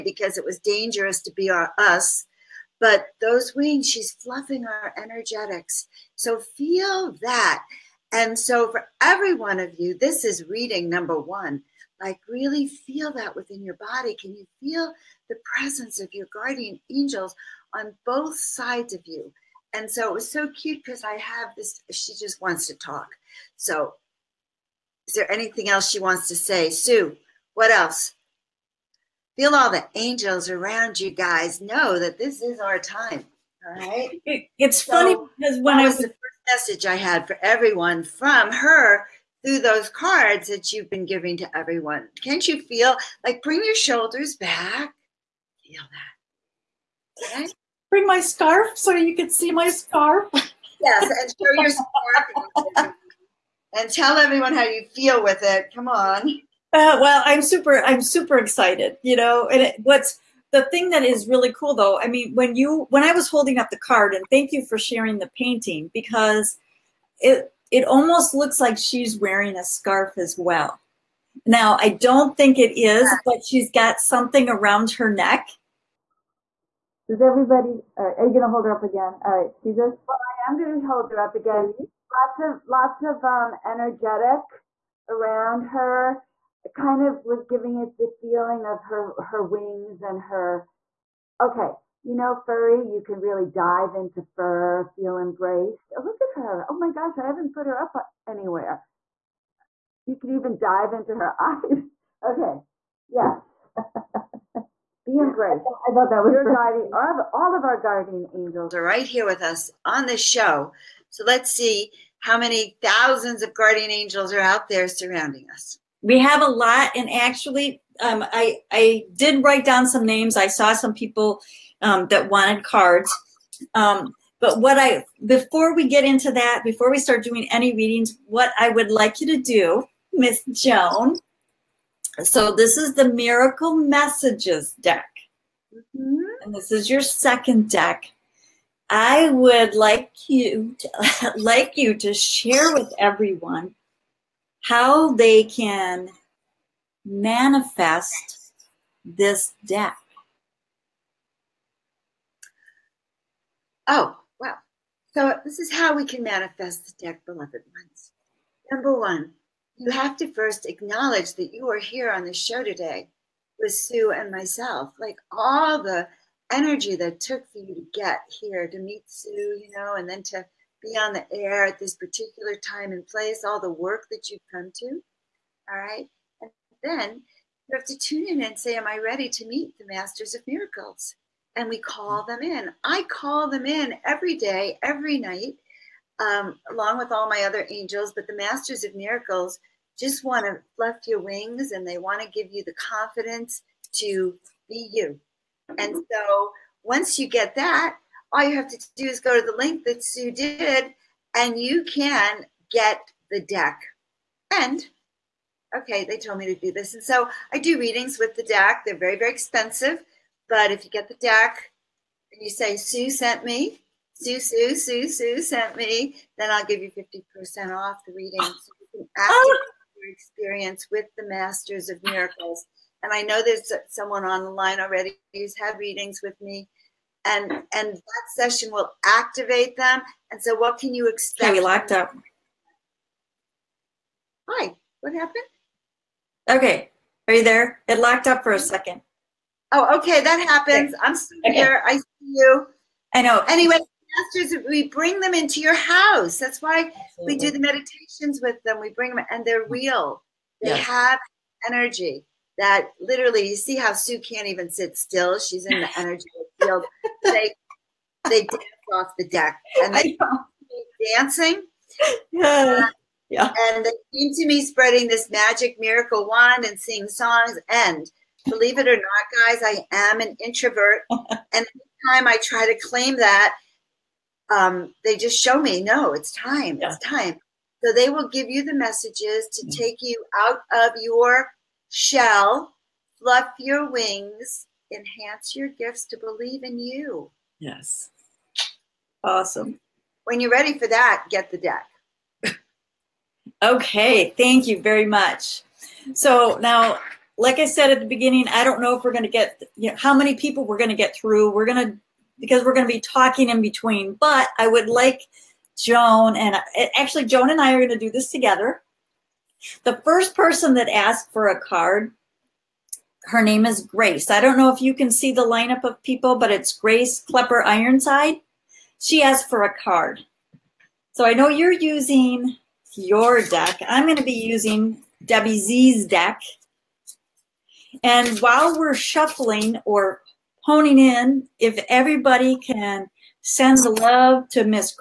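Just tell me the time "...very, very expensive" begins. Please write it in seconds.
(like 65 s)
208 s.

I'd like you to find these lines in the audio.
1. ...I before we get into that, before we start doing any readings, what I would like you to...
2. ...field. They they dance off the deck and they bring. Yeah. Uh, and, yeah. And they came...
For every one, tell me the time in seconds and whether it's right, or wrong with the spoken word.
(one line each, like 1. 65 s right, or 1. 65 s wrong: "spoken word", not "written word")
1. 124 s right
2. 256 s wrong: "dancing", not "bring".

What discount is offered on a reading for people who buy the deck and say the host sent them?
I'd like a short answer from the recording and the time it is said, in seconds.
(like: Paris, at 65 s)
50%, at 216 s.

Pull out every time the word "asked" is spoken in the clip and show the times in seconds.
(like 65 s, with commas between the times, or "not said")
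310 s, 319 s.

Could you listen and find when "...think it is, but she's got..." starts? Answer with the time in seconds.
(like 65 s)
72 s.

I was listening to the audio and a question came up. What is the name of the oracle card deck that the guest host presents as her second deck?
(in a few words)
Miracle Messages.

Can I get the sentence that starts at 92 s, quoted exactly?
You can really dive into fur, feel embraced.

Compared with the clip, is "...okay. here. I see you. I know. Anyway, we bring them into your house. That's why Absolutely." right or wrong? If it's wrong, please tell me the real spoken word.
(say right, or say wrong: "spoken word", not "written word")
right.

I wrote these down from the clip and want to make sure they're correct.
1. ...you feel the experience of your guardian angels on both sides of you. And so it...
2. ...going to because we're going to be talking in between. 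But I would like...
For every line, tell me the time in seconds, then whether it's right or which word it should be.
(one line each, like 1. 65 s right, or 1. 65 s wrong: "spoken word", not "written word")
1. 14 s wrong: "presence", not "experience"
2. 301 s right.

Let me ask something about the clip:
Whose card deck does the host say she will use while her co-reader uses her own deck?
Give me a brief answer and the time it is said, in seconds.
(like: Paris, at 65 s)
Debbie Z, at 325 s.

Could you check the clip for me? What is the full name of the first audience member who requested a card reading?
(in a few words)
Grace Klepper Ironside.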